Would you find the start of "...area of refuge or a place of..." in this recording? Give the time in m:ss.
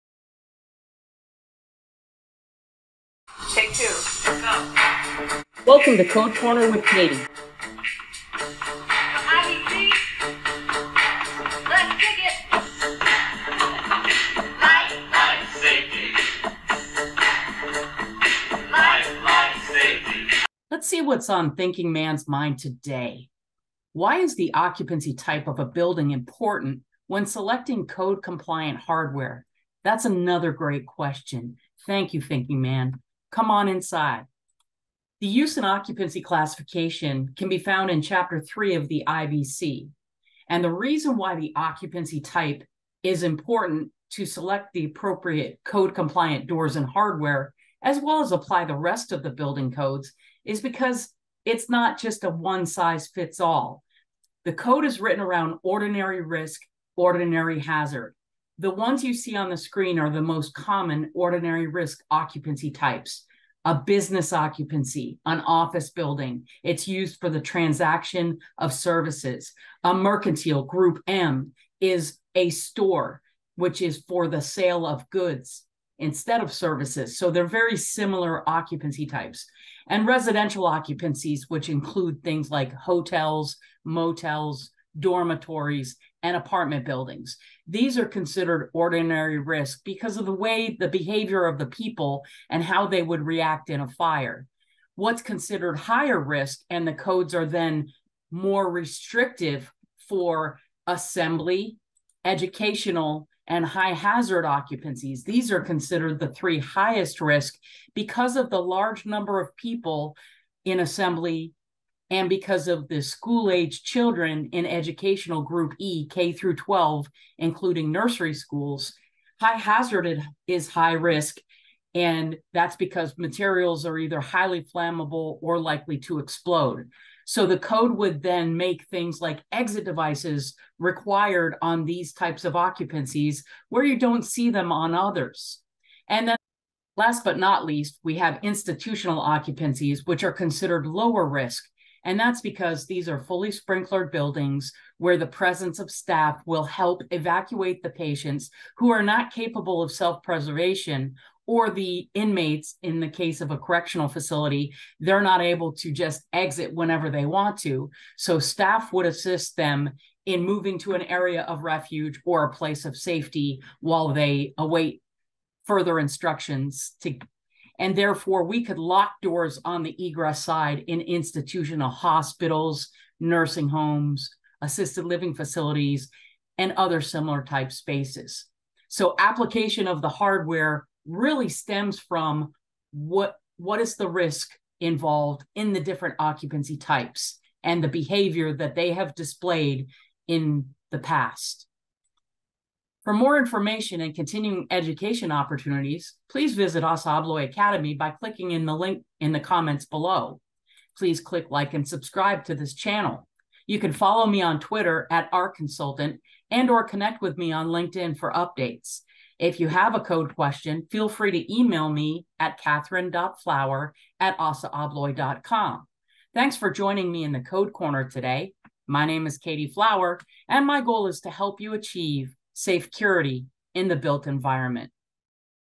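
2:41.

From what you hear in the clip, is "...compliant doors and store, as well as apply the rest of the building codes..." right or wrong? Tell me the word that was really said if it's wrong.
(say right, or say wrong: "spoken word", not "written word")
wrong: "hardware", not "store".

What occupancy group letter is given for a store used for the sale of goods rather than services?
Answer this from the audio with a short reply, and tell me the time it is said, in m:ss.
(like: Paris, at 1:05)
Group M, at 1:10.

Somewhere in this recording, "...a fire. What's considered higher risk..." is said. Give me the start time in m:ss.
1:33.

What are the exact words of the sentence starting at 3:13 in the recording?
For more information and continuing education opportunities, please visit us Academy by clicking in the link in the comments below.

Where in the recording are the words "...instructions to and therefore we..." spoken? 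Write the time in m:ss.
2:45.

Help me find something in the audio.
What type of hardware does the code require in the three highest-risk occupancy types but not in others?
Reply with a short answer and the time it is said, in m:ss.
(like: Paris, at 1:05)
exit devices, at 2:09.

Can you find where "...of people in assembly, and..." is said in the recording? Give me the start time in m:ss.
1:49.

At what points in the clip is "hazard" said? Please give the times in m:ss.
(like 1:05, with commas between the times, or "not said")
0:57, 1:43, 1:59.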